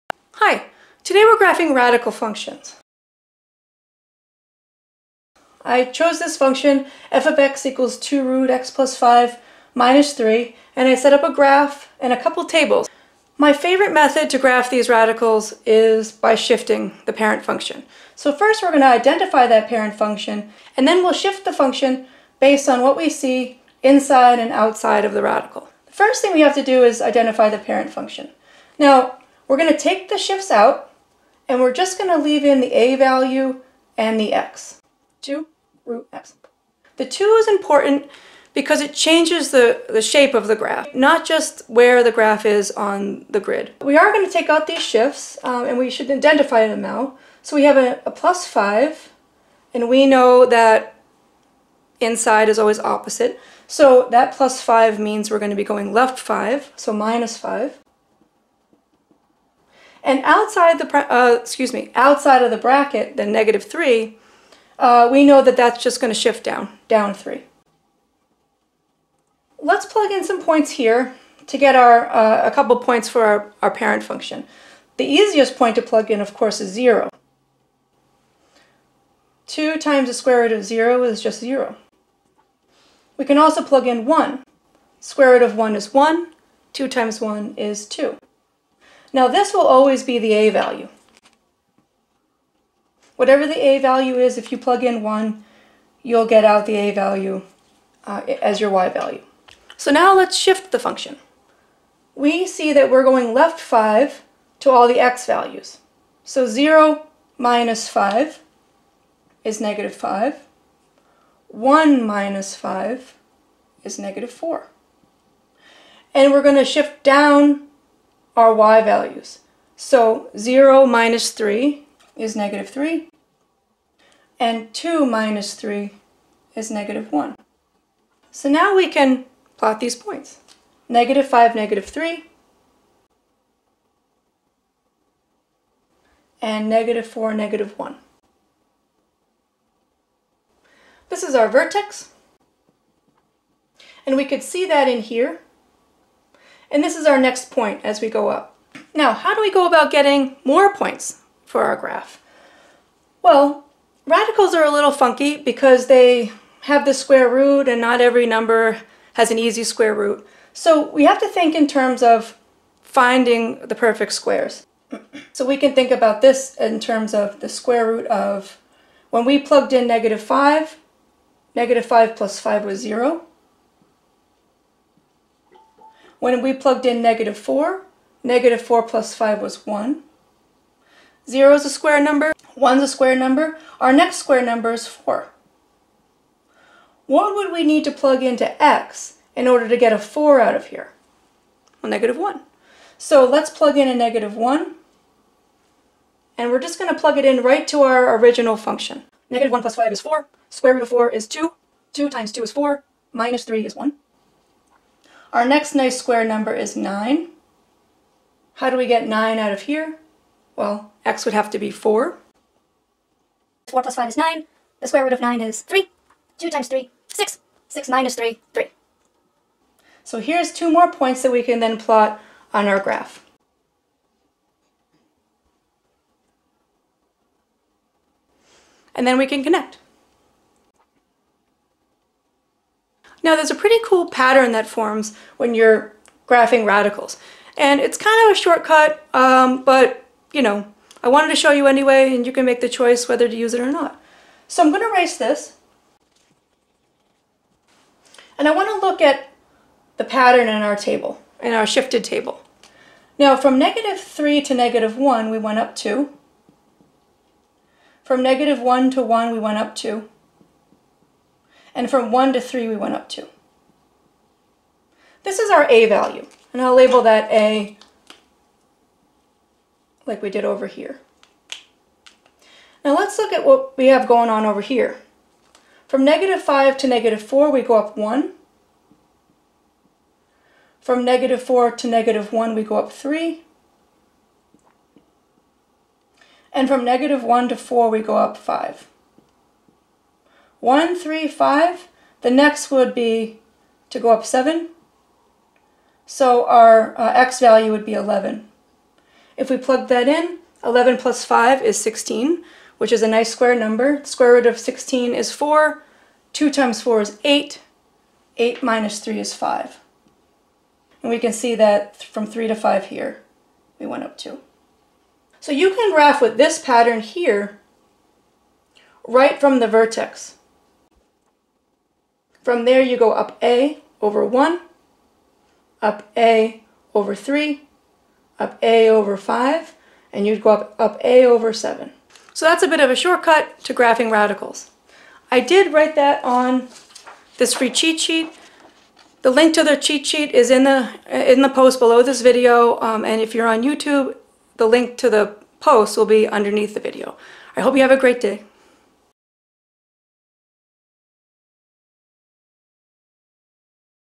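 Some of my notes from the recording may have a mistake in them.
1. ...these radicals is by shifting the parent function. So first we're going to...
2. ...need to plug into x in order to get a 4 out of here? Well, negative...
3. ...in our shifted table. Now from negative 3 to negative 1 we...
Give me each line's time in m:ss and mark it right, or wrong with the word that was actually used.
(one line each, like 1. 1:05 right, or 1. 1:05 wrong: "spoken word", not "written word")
1. 0:14 right
2. 3:07 right
3. 4:11 right.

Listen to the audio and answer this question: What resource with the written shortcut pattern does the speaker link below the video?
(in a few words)
free cheat sheet.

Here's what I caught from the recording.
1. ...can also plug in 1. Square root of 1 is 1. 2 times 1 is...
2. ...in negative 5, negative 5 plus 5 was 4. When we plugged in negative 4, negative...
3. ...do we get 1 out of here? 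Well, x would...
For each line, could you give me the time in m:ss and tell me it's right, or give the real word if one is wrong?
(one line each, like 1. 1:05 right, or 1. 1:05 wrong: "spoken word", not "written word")
1. 1:23 right
2. 2:49 wrong: "0", not "4"
3. 3:28 wrong: "9", not "1".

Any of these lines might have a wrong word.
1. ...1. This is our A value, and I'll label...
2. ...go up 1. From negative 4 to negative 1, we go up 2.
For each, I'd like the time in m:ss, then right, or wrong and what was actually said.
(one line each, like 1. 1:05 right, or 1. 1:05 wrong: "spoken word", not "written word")
1. 4:23 wrong: "2", not "1"
2. 4:37 wrong: "3", not "2".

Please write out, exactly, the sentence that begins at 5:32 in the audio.
So that's a bit of a shortcut to graphing radicals.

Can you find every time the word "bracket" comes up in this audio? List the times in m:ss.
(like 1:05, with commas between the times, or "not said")
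1:02.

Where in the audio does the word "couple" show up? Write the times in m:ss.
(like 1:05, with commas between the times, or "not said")
0:12, 1:12.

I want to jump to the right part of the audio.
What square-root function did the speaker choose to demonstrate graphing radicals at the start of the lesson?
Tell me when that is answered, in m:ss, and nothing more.
0:07.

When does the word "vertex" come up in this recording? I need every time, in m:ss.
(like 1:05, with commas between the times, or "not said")
2:21, 5:19.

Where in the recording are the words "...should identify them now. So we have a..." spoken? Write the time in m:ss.
0:45.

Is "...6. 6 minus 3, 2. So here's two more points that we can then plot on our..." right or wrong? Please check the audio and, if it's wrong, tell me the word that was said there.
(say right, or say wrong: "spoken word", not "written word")
wrong: "3", not "2".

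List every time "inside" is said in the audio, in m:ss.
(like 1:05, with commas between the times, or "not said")
0:23, 0:51.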